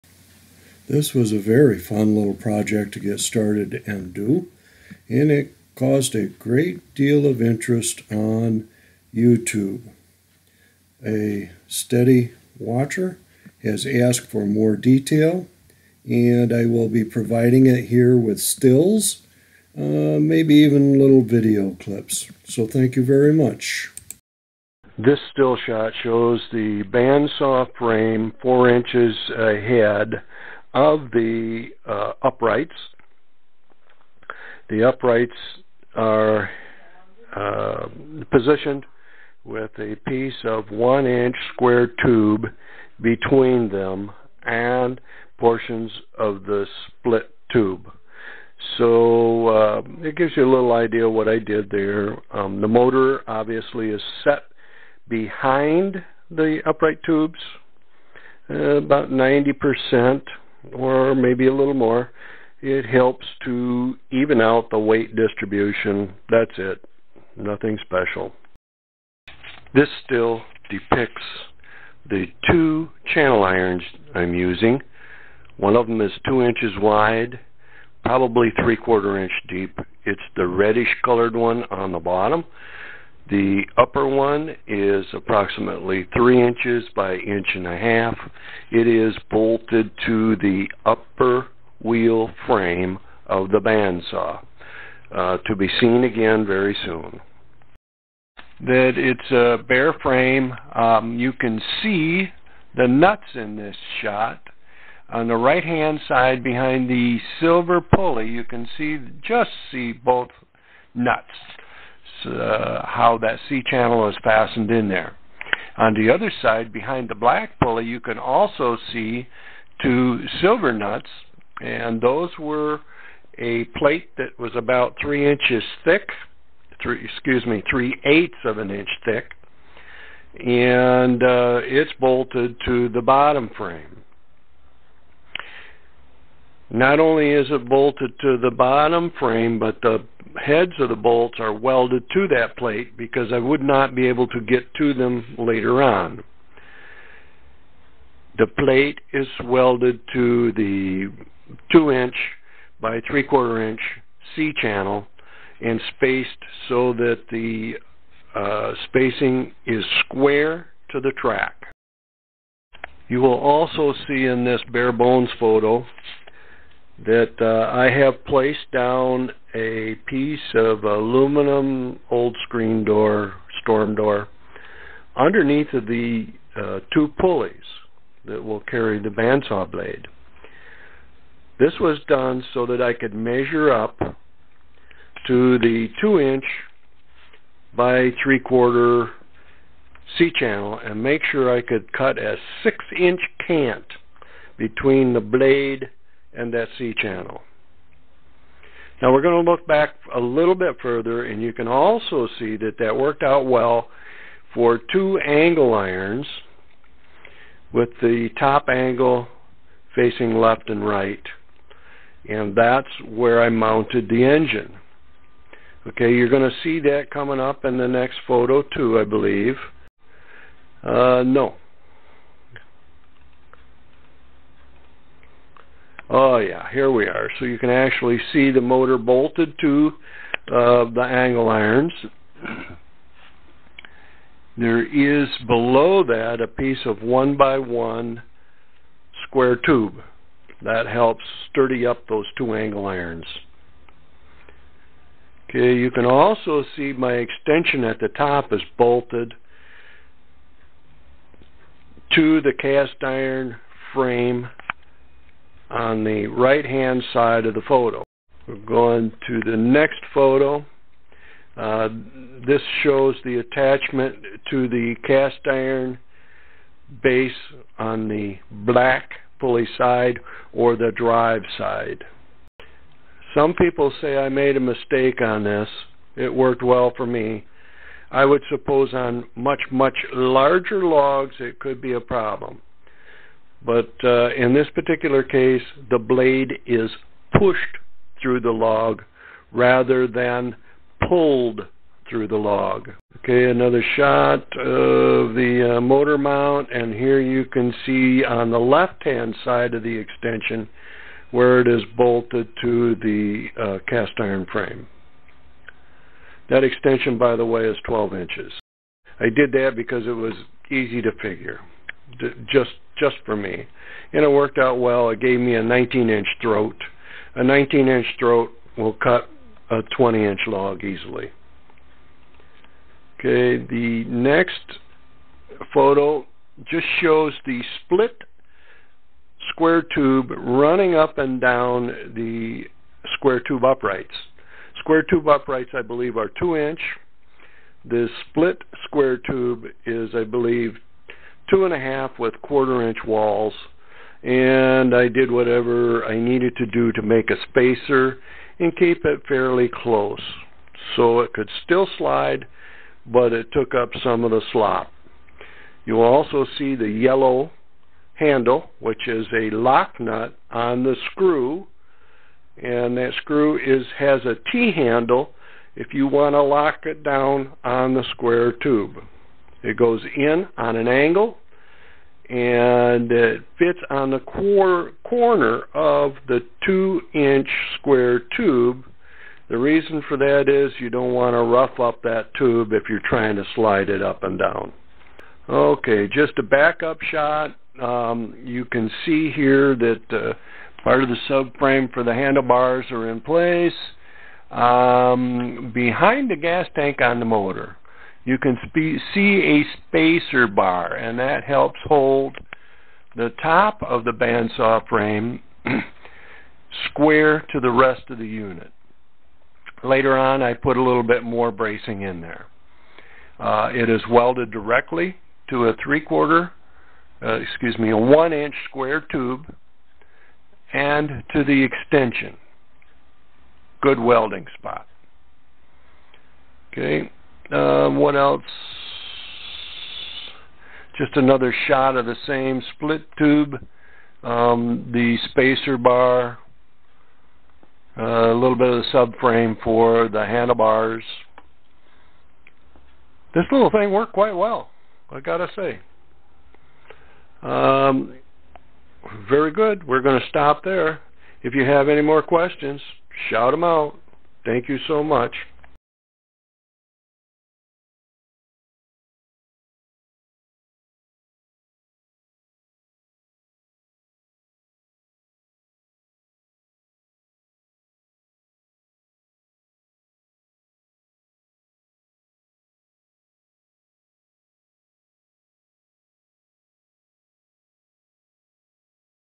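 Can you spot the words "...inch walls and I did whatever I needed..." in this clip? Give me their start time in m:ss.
5:42.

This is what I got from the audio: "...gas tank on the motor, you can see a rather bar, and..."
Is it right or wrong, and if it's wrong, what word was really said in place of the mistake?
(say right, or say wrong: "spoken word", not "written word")
wrong: "spacer", not "rather".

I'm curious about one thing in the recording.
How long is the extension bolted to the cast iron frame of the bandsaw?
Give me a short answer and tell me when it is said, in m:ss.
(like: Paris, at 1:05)
12 inches, at 5:07.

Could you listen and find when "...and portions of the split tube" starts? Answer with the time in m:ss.
0:44.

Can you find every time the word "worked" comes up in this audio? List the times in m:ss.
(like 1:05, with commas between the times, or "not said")
3:22, 4:36, 5:14, 7:23.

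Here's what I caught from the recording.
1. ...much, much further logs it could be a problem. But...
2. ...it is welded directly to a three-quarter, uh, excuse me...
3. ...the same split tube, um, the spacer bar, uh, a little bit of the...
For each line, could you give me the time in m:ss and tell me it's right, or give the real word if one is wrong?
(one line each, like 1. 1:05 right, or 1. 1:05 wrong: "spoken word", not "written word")
1. 4:39 wrong: "larger", not "further"
2. 6:53 right
3. 7:12 right.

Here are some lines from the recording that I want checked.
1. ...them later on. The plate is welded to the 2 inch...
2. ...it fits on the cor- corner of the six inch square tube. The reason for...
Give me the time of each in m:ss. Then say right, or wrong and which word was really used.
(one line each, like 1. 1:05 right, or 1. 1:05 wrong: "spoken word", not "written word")
1. 2:24 right
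2. 6:13 wrong: "two", not "six".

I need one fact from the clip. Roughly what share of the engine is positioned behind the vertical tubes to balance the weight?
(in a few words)
90%.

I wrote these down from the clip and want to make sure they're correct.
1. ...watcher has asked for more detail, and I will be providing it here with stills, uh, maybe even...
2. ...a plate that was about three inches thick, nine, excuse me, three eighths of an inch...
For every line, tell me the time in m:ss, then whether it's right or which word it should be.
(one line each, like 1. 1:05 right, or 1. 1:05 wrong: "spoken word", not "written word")
1. 0:12 right
2. 2:03 wrong: "three", not "nine".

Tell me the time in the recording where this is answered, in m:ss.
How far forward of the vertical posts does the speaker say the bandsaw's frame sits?
0:28.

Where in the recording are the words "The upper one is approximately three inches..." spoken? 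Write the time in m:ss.
1:23.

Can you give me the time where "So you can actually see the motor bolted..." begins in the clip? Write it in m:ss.
3:47.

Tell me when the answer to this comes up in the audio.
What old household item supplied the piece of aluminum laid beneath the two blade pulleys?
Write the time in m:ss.
2:53.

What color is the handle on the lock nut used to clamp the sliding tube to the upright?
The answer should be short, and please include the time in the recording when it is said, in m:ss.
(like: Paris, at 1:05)
yellow, at 5:56.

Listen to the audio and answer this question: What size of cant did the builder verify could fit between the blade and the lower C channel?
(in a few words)
6 inch.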